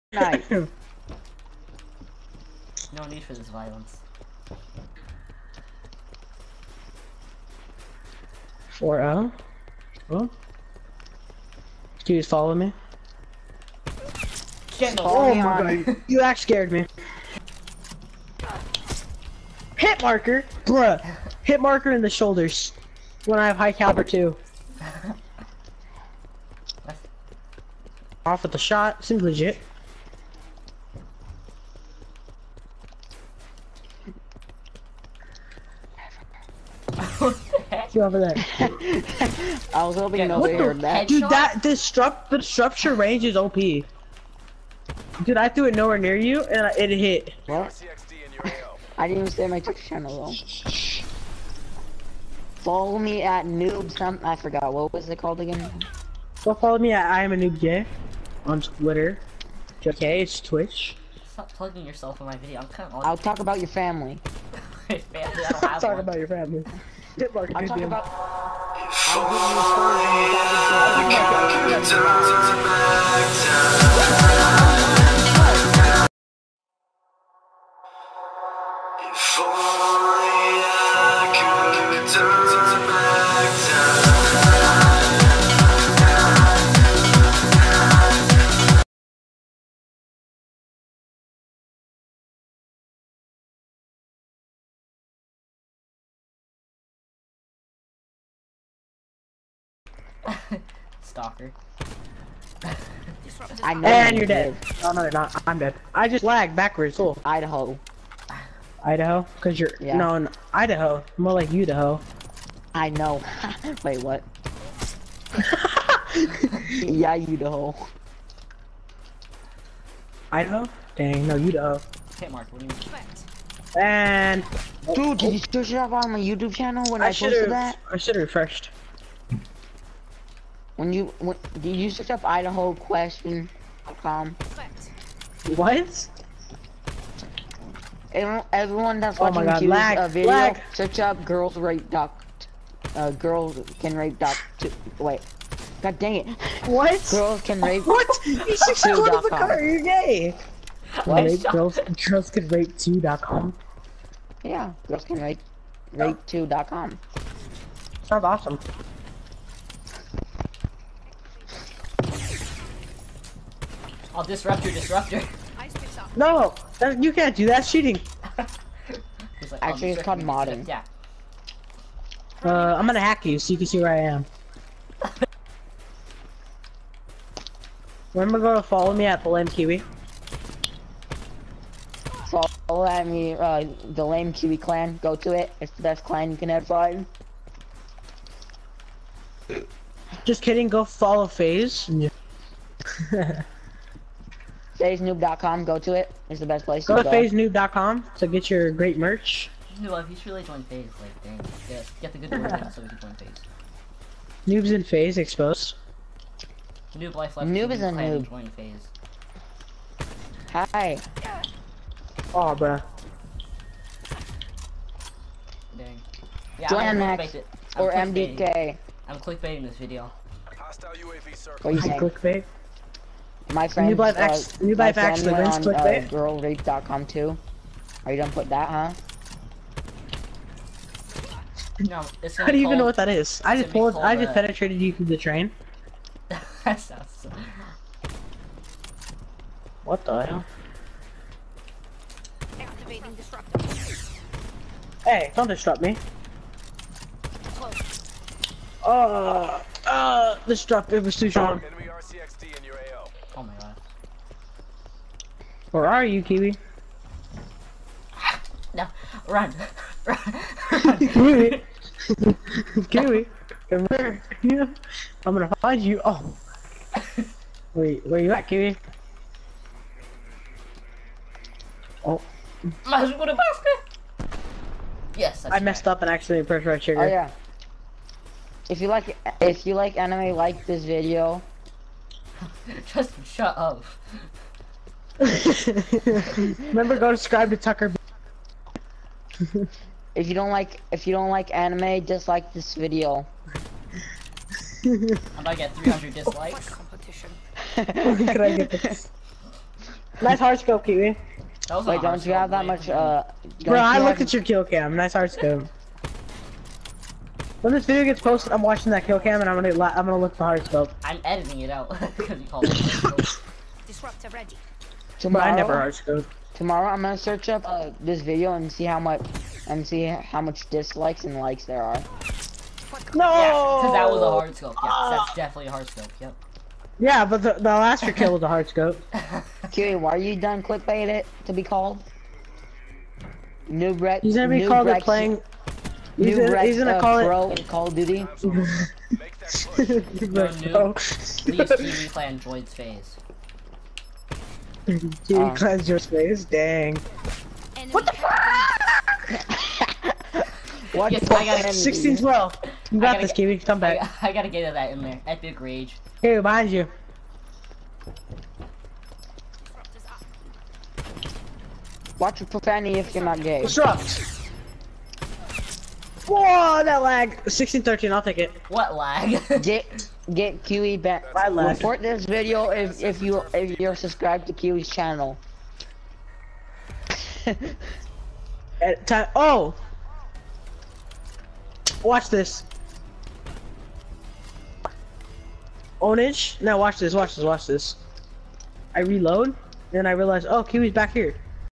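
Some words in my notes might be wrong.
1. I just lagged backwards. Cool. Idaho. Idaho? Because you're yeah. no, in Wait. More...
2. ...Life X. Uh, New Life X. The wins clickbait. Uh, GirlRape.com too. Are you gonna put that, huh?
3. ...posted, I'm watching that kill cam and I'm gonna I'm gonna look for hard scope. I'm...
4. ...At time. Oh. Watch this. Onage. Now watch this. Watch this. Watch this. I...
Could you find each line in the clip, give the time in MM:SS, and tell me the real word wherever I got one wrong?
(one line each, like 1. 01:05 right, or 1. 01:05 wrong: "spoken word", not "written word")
1. 01:45 wrong: "Idaho", not "Wait"
2. 03:43 right
3. 05:08 right
4. 06:18 right.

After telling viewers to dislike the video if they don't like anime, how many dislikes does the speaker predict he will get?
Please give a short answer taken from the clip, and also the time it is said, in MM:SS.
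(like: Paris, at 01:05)
300, at 04:55.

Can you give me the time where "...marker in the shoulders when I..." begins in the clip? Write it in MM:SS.
00:21.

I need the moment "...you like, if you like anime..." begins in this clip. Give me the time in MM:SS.
04:38.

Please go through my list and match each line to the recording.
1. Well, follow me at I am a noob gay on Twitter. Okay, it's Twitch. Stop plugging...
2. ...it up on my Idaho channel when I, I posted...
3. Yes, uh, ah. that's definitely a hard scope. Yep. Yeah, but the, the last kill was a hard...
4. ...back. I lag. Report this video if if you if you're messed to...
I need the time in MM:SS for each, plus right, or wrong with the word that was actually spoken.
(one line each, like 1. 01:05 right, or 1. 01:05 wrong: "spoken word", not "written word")
1. 00:56 right
2. 02:05 wrong: "YouTube", not "Idaho"
3. 05:24 right
4. 06:10 wrong: "subscribed", not "messed".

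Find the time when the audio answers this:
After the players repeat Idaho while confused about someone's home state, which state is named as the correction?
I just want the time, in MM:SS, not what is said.
02:01.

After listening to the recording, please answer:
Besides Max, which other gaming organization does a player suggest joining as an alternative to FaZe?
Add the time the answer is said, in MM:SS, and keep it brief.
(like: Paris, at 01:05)
MDK, at 03:37.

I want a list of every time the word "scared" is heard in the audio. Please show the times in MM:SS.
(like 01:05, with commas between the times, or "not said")
00:16.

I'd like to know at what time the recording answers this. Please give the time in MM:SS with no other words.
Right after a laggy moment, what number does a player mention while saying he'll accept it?
06:07.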